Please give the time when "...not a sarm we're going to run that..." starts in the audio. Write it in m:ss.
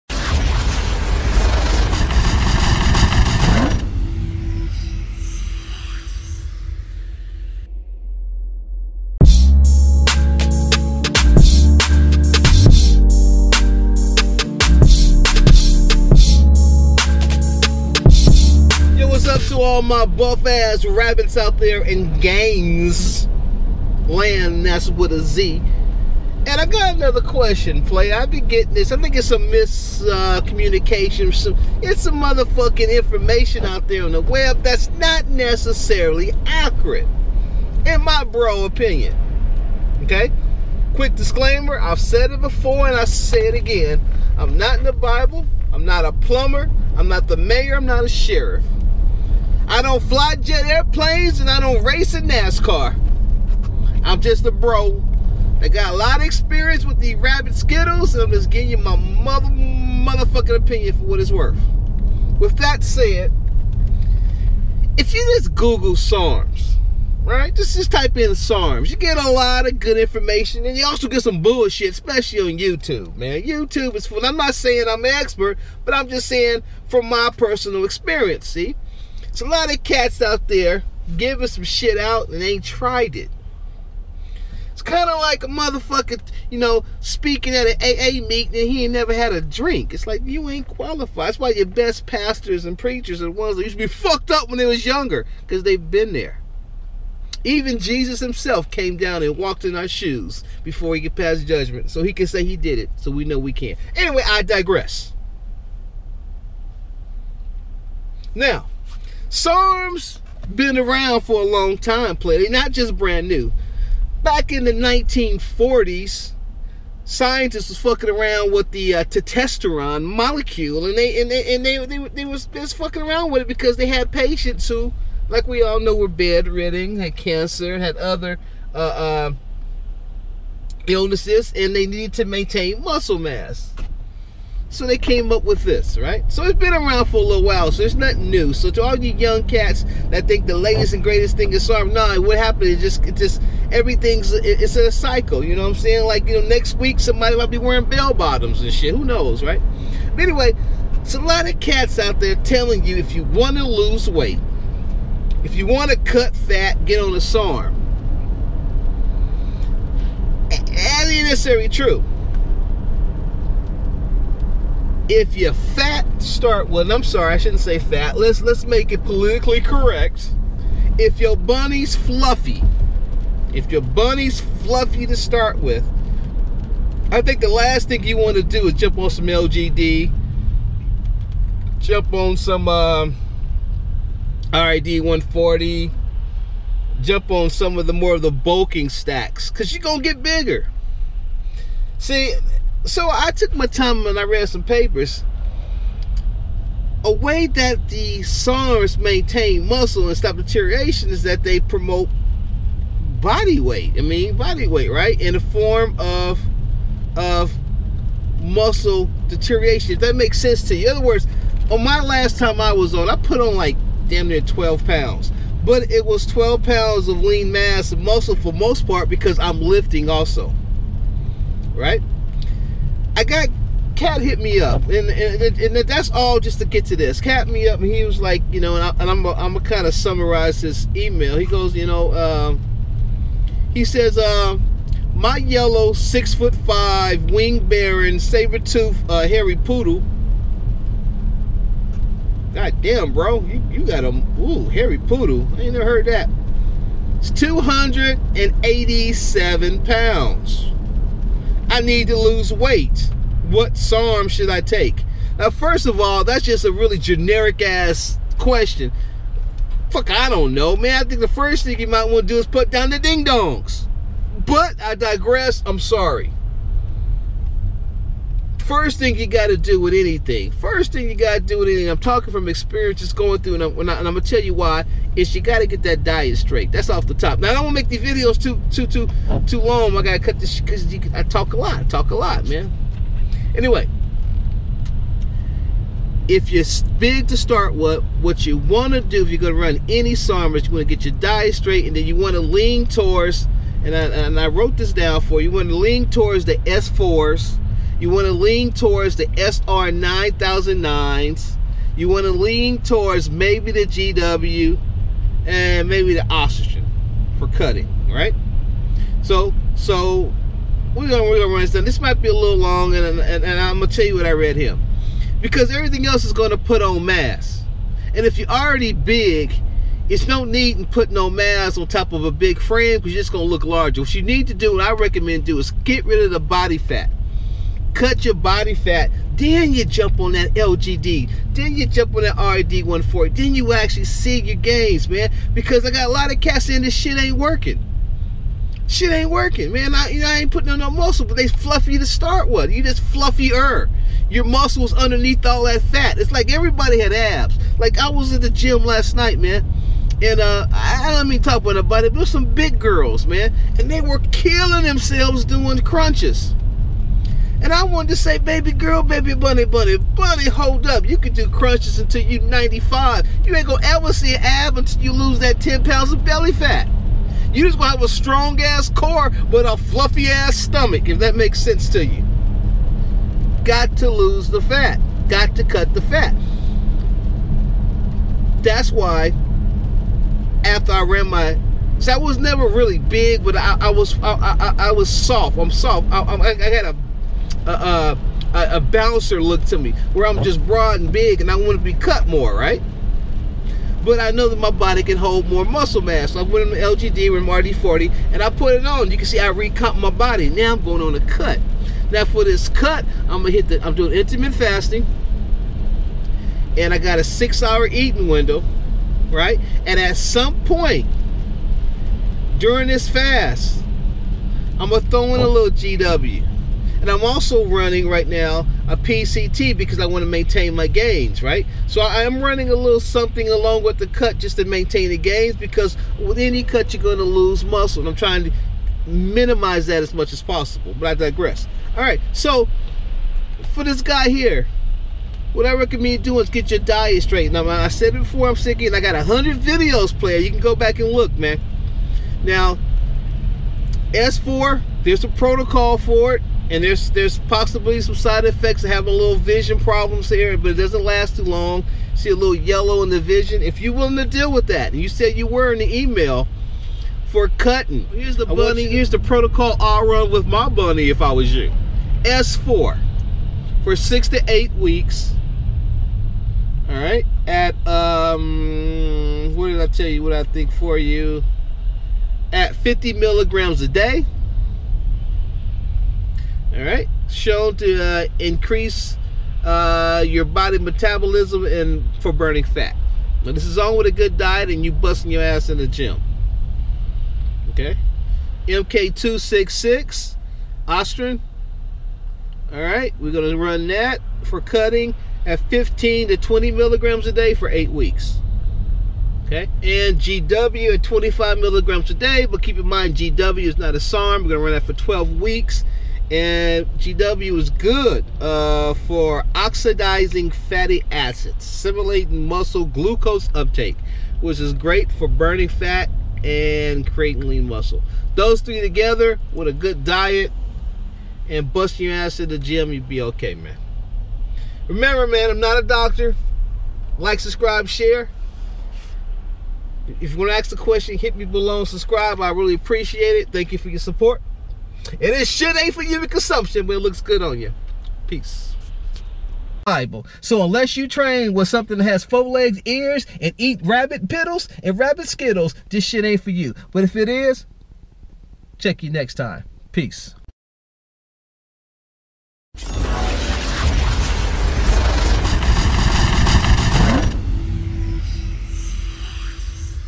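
8:23.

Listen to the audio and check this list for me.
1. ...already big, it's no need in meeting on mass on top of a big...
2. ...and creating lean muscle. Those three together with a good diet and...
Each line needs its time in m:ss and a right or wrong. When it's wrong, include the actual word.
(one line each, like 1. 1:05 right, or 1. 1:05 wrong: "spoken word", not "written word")
1. 5:18 wrong: "putting", not "meeting"
2. 8:36 right.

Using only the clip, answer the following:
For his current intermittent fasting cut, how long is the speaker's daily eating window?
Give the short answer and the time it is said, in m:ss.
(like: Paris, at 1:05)
6 hours, at 6:47.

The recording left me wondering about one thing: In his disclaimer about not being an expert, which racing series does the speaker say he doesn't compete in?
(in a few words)
NASCAR.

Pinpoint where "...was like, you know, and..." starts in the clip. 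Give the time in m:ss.
3:48.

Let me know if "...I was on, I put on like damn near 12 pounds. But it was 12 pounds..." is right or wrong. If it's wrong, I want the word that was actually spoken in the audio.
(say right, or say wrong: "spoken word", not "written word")
right.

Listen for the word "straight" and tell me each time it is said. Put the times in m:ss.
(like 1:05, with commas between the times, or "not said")
4:36, 4:51, 7:17.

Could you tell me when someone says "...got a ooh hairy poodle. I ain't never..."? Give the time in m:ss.
4:03.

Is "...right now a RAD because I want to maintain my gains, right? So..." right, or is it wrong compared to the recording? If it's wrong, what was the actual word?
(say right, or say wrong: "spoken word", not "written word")
wrong: "PCT", not "RAD".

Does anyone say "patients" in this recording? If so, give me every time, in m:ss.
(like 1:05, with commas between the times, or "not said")
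2:04.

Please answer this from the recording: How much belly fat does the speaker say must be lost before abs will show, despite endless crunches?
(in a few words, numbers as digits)
10 pounds.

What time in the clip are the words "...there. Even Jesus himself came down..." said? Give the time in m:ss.
1:36.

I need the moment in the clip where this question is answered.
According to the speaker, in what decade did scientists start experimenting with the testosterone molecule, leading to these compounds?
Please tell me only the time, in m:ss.
1:54.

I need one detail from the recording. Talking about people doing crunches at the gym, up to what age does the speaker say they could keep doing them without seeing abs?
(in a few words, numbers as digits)
95.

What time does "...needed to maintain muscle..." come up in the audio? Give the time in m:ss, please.
2:11.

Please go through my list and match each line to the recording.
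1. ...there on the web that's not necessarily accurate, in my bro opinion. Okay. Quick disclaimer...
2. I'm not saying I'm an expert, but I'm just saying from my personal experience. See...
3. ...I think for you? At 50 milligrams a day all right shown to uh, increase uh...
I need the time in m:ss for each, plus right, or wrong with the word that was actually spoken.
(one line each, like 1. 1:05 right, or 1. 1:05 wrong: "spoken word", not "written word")
1. 0:33 right
2. 1:14 right
3. 7:50 right.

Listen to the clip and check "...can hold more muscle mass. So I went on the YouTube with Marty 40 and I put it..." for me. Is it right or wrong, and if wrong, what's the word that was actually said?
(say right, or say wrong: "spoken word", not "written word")
wrong: "LGD", not "YouTube".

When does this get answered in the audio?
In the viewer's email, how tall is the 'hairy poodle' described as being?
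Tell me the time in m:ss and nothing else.
3:55.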